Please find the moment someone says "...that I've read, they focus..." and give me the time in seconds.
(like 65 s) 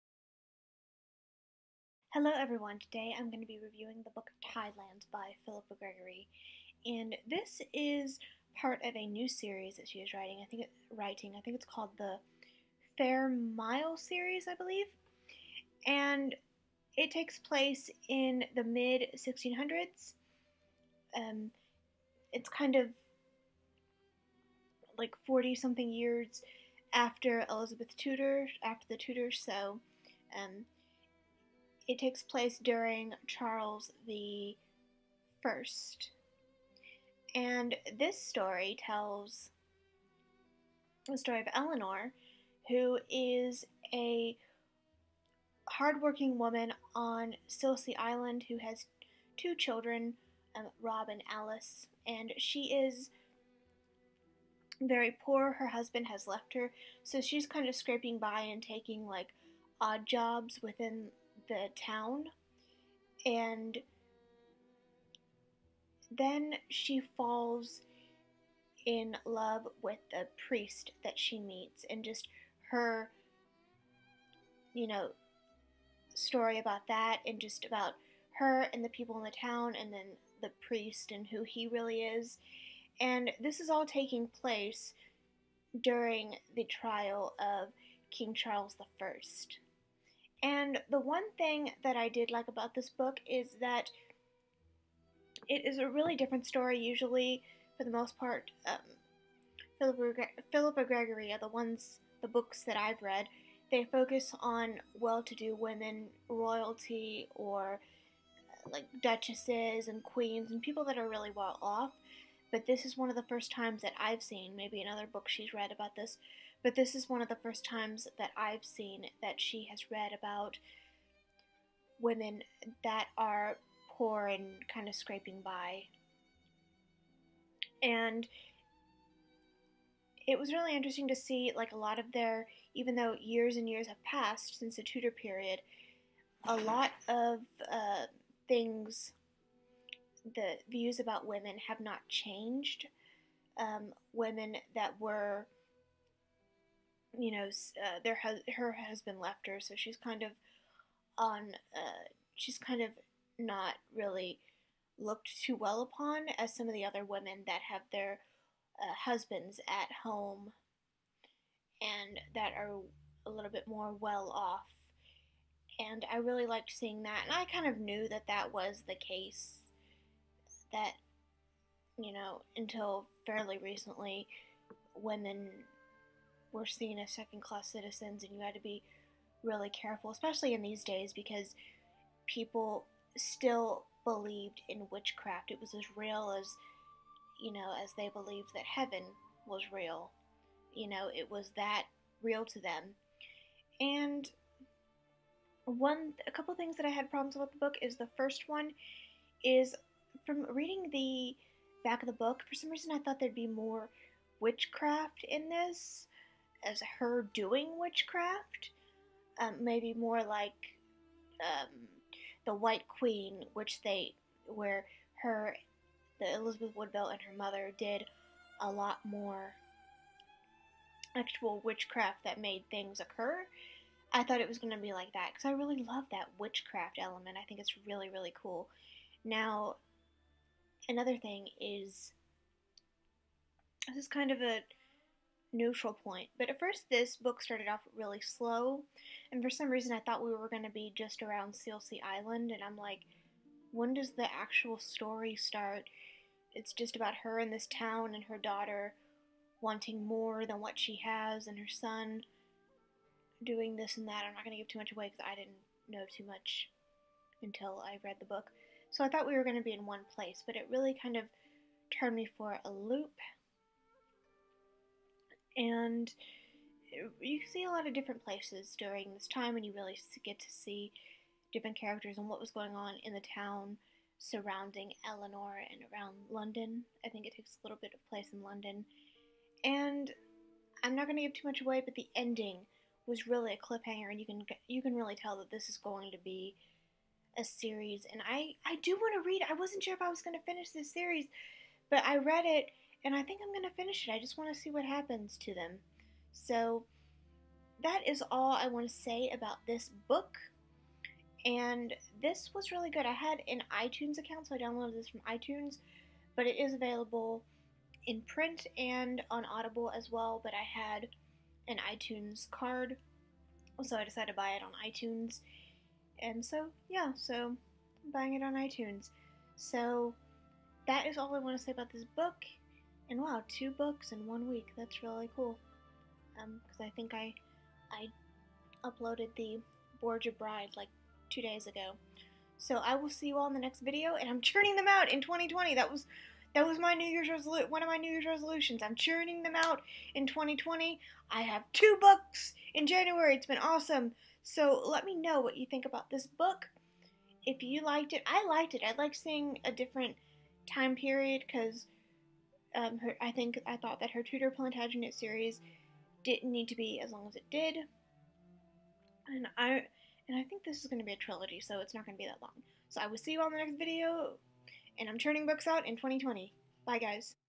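102 s.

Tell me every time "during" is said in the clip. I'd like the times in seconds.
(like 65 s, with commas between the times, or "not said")
32 s, 85 s, 268 s.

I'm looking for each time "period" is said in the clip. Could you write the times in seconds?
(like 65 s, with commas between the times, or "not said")
135 s, 350 s.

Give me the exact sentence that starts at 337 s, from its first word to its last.
One of my New Year's resolutions.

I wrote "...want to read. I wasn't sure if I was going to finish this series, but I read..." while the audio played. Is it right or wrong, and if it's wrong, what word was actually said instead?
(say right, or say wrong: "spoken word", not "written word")
right.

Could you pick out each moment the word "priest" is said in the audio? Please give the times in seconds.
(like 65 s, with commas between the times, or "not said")
70 s, 80 s.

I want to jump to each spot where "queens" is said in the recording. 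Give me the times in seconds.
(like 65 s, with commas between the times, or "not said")
110 s, 212 s.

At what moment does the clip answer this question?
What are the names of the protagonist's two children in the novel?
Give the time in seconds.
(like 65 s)
50 s.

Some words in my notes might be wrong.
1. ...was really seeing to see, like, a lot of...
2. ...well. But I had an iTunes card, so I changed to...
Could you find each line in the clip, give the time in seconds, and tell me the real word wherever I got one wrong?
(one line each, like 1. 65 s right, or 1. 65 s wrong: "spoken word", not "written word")
1. 130 s wrong: "interesting", not "seeing"
2. 310 s wrong: "decided", not "changed".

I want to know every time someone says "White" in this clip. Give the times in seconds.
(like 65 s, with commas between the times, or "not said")
212 s.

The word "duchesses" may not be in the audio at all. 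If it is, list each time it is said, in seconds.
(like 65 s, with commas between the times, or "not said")
109 s.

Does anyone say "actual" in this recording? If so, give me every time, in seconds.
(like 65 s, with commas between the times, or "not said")
221 s, 244 s.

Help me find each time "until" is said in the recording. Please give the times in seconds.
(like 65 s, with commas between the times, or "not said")
172 s, 257 s.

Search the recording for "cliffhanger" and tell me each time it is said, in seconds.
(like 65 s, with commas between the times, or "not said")
283 s.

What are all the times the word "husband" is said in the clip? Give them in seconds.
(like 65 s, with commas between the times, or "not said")
55 s, 148 s, 159 s.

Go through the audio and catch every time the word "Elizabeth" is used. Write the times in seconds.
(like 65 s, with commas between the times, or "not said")
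27 s, 216 s.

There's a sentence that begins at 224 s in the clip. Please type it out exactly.
I thought it was going to be like that because I really love that witchcraft element.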